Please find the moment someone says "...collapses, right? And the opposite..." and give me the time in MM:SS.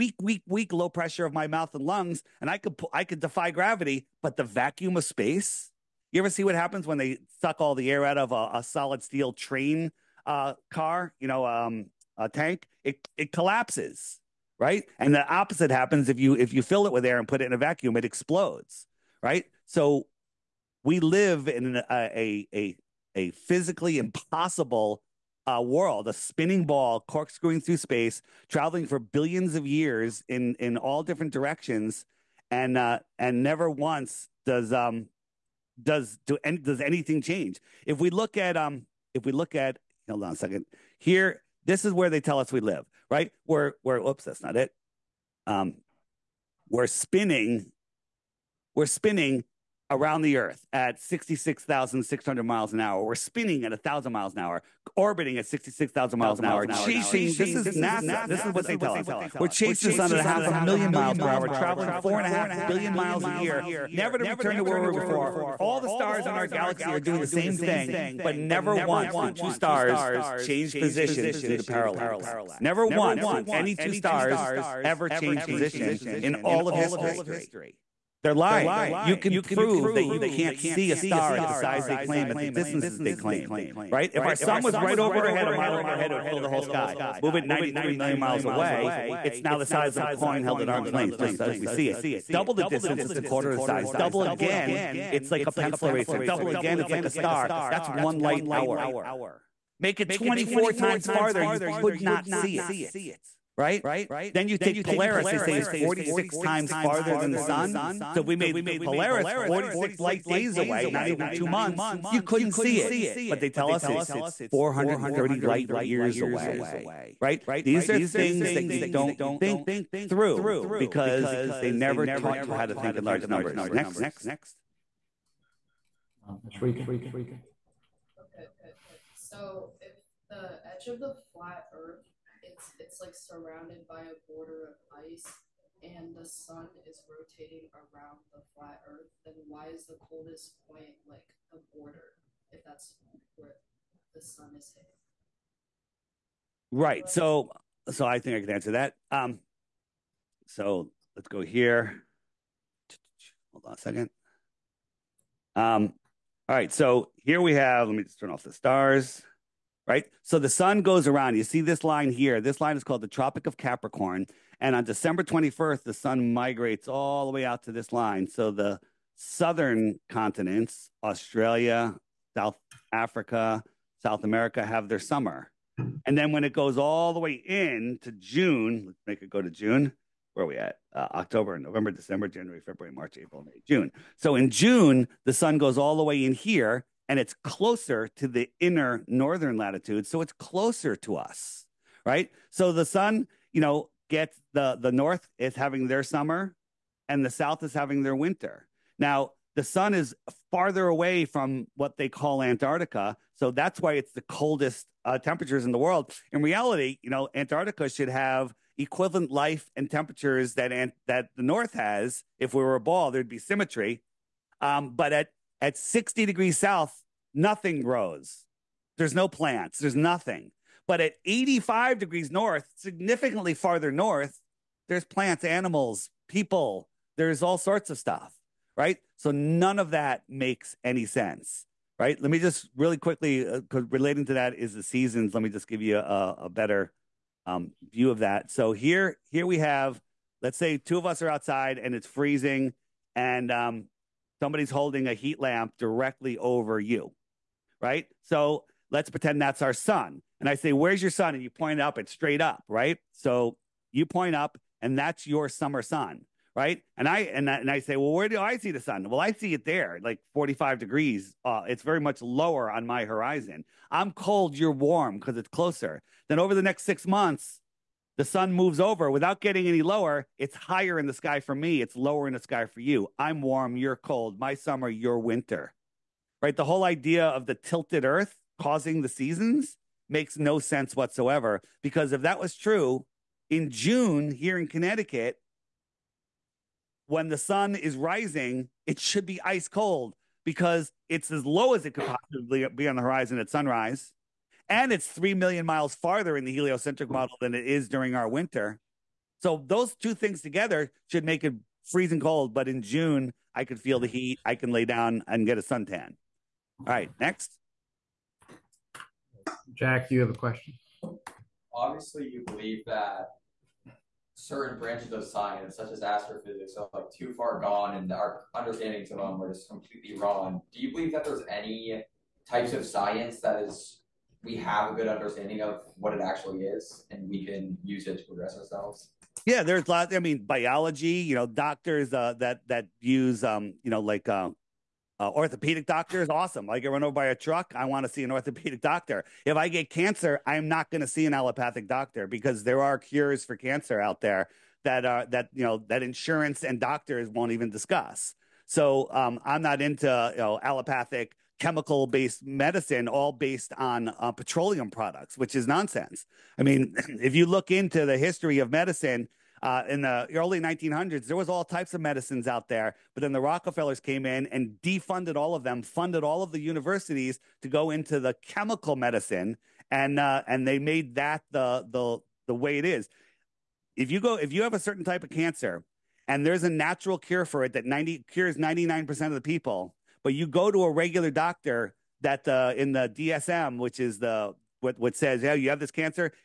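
00:13.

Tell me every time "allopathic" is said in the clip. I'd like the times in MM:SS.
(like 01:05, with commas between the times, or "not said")
05:41, 05:50.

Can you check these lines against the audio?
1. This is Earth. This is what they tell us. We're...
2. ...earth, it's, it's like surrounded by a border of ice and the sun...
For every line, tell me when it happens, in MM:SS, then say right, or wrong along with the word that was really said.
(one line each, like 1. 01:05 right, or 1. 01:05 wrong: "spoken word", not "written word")
1. 00:57 wrong: "NASA", not "Earth"
2. 02:11 right.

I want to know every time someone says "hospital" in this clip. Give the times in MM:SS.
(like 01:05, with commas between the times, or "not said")
not said.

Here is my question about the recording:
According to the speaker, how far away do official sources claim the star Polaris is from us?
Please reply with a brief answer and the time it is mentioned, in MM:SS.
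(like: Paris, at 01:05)
430 light years, at 01:54.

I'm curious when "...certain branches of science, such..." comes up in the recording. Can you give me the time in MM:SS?
05:14.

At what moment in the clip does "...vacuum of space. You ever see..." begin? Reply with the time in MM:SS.
00:04.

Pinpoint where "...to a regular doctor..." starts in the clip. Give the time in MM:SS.
06:20.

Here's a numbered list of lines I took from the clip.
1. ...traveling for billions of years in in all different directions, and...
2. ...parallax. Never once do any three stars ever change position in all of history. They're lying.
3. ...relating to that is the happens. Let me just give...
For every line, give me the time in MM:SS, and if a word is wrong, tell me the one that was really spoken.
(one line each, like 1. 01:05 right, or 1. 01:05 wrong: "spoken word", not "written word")
1. 00:28 right
2. 01:11 wrong: "two", not "three"
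3. 03:53 wrong: "seasons", not "happens".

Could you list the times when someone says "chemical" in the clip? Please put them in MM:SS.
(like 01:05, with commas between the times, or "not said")
05:51, 06:08.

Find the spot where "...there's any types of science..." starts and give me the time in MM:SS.
05:21.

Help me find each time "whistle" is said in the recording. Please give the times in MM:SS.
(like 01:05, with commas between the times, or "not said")
not said.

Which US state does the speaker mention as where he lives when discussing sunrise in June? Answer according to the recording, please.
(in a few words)
Connecticut.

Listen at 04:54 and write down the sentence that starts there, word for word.
And it's 3 million miles farther in the heliocentric model than it is during our winter.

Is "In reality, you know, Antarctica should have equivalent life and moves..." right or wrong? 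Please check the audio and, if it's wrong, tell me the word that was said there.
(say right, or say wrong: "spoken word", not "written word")
wrong: "temperatures", not "moves".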